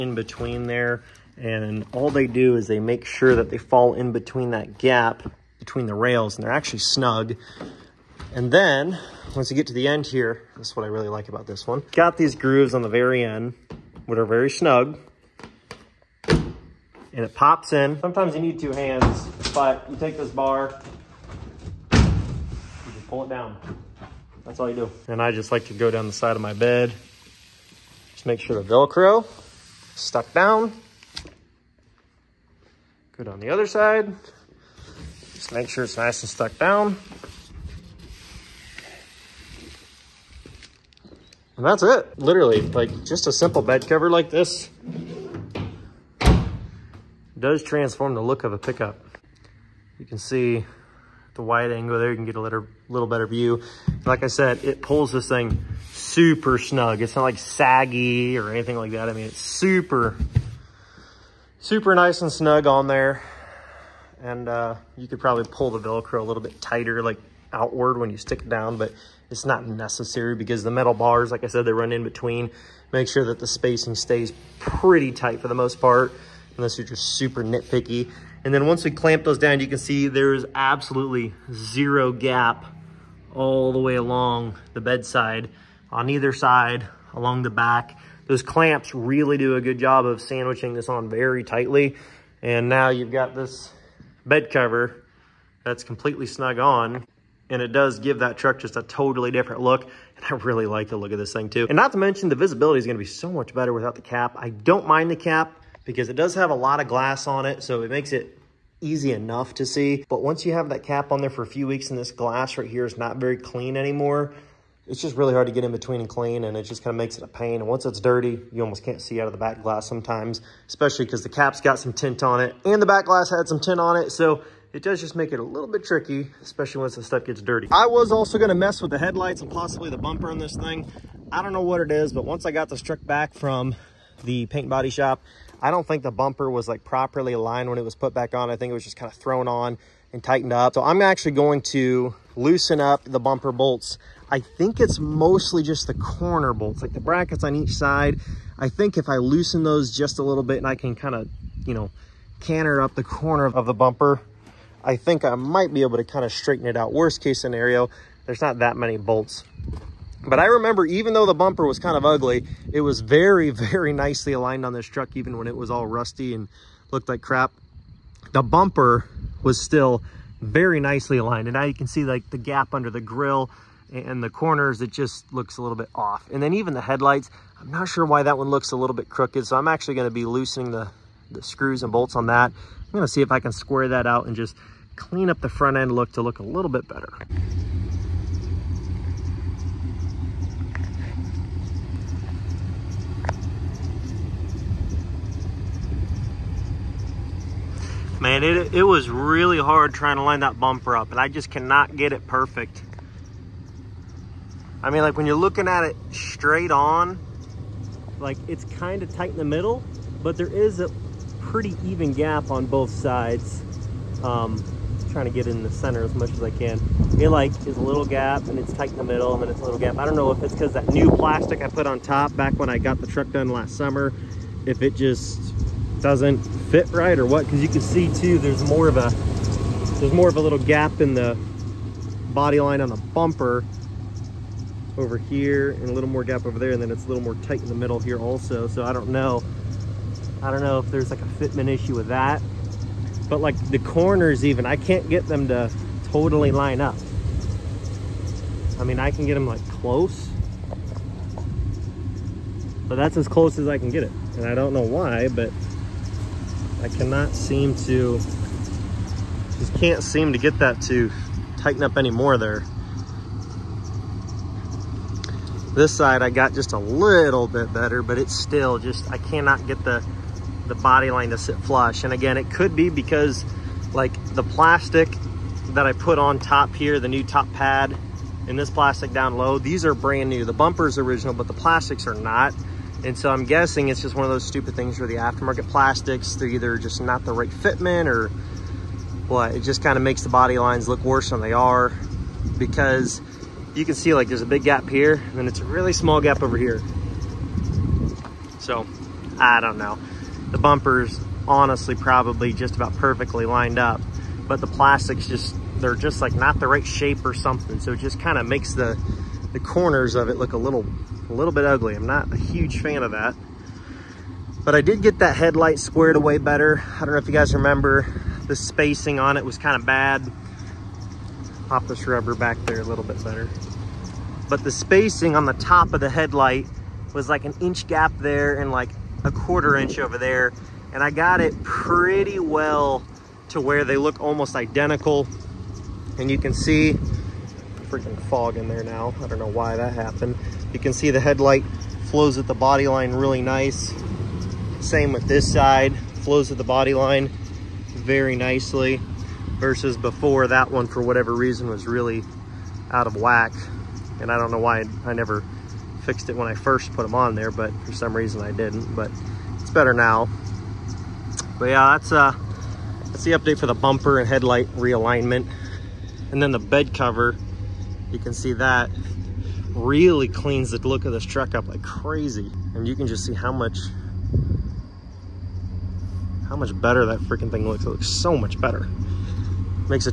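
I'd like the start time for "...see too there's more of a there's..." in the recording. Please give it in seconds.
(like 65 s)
227 s.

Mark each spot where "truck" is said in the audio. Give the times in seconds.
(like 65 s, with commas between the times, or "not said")
98 s, 132 s, 164 s, 223 s, 371 s.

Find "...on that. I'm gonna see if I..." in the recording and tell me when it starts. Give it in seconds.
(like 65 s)
182 s.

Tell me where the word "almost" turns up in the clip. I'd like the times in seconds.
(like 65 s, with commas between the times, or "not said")
118 s, 334 s.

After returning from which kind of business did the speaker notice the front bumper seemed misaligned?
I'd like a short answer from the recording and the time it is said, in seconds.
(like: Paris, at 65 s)
paint body shop, at 134 s.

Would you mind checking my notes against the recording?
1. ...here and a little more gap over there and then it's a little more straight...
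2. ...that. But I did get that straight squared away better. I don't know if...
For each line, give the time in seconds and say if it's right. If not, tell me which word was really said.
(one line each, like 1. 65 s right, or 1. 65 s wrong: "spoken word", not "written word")
1. 235 s wrong: "tight", not "straight"
2. 313 s wrong: "headlight", not "straight".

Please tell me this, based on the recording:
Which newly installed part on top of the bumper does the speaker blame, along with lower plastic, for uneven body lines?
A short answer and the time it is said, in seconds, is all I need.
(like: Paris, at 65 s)
top pad, at 277 s.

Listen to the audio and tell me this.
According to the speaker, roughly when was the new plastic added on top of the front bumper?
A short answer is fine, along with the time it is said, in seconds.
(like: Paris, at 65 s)
last summer, at 223 s.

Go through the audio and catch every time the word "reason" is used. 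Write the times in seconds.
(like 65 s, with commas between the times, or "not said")
351 s, 358 s.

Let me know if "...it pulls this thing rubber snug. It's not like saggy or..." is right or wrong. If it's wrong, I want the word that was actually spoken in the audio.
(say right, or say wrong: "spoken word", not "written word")
wrong: "super", not "rubber".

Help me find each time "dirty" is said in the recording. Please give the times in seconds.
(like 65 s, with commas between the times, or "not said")
118 s, 127 s.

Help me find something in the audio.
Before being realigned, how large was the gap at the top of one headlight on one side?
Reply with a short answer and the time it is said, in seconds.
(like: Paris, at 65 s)
an inch, at 327 s.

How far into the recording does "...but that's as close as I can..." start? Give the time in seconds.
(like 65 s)
252 s.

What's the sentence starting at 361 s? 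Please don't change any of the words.
But yeah, that's uh, that's the update for the bumper and headlight realignment.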